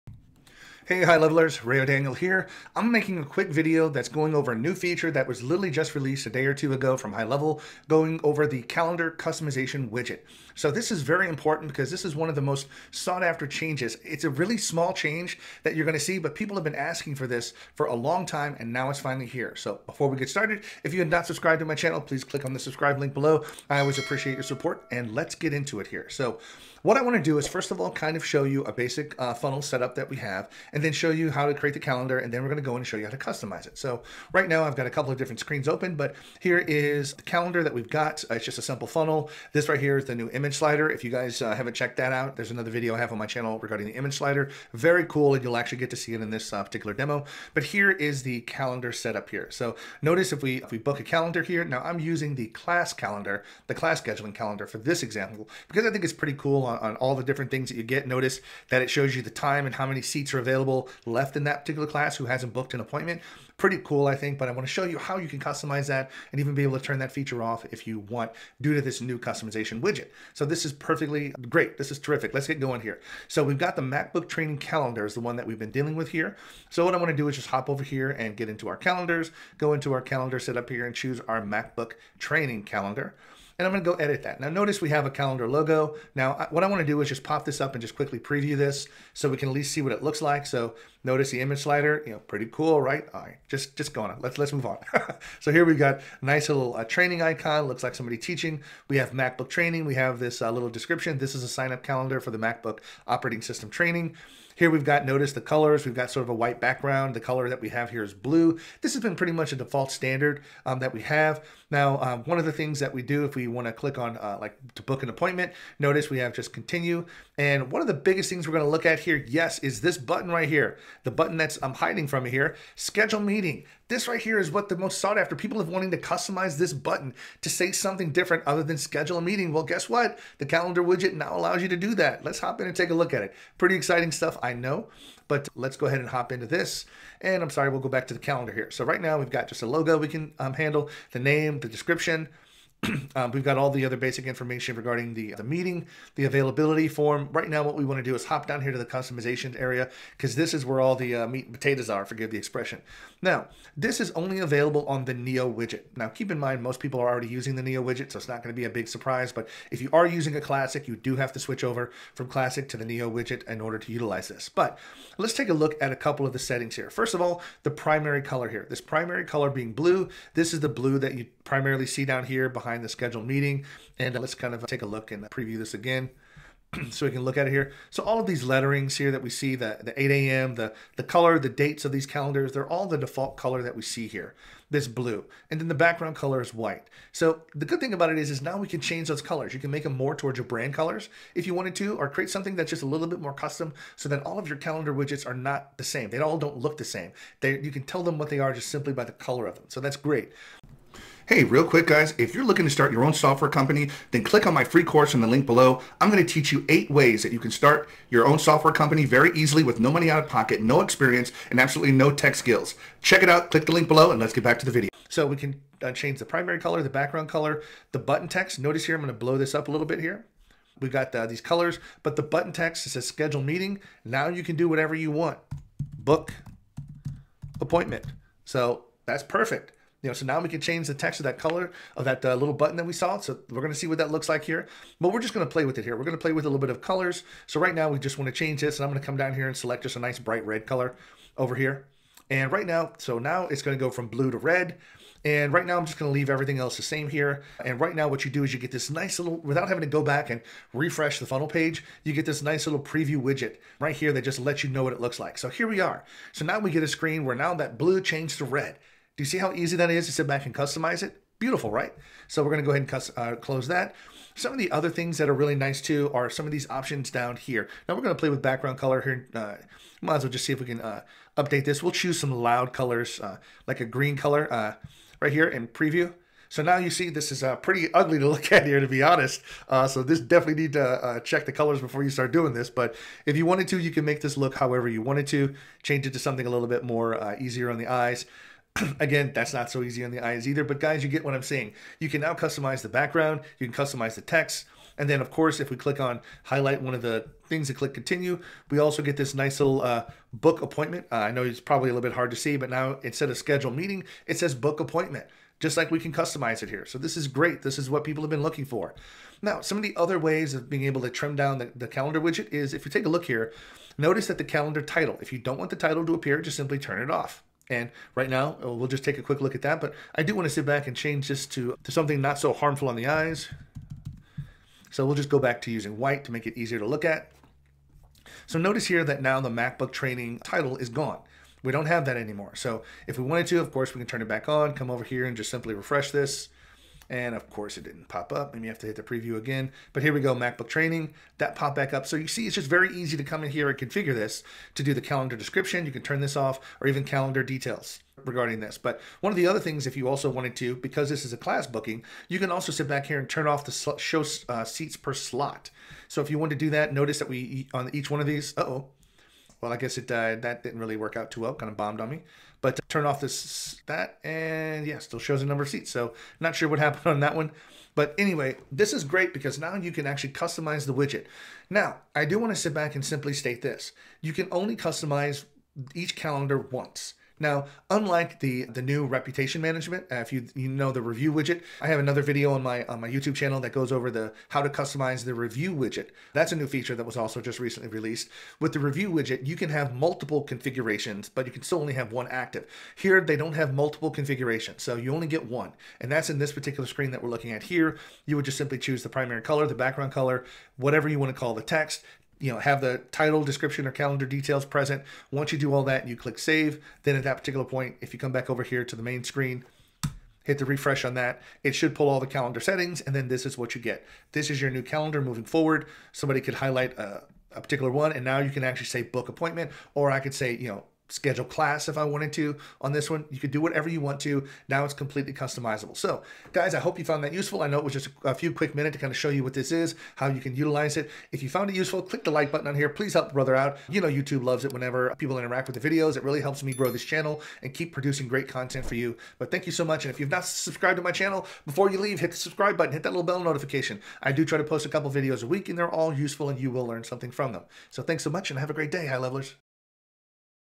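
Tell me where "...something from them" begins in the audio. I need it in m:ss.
7:27.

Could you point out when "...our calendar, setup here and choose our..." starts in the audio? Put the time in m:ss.
1:19.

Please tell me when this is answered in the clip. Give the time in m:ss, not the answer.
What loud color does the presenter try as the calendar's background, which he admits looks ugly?
4:33.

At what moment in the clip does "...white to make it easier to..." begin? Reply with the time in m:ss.
5:25.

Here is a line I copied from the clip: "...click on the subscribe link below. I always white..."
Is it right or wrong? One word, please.
wrong.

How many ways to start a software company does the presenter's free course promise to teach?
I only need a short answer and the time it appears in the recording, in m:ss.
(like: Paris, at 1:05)
8, at 3:26.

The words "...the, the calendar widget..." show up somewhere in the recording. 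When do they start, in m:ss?
5:11.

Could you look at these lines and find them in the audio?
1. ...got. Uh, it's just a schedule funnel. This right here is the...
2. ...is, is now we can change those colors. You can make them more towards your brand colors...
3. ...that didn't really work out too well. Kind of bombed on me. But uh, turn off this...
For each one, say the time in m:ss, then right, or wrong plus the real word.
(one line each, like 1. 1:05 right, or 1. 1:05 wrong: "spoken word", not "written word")
1. 0:37 wrong: "simple", not "schedule"
2. 3:08 right
3. 6:00 right.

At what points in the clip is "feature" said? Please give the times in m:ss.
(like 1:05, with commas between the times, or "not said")
0:04, 1:07, 6:26.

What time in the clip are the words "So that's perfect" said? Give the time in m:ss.
3:48.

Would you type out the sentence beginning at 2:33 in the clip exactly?
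Now, this is only available on the Neo widget.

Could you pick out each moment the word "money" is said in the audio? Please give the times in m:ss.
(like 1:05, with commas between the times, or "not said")
3:29.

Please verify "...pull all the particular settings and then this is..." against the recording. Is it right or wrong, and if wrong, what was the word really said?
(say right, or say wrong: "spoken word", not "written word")
wrong: "calendar", not "particular".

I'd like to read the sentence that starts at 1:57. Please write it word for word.
And one of the biggest things we're gonna look at here, yes, is this button right here.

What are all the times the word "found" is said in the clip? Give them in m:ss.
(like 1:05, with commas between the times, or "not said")
7:07, 7:11.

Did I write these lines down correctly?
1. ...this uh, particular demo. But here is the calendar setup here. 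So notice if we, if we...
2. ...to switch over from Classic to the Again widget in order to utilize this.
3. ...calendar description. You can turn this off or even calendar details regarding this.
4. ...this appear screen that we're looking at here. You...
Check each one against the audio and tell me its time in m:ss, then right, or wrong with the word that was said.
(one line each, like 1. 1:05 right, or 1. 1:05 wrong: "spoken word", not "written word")
1. 0:46 right
2. 2:41 wrong: "Neo", not "Again"
3. 5:45 right
4. 6:36 wrong: "particular", not "appear".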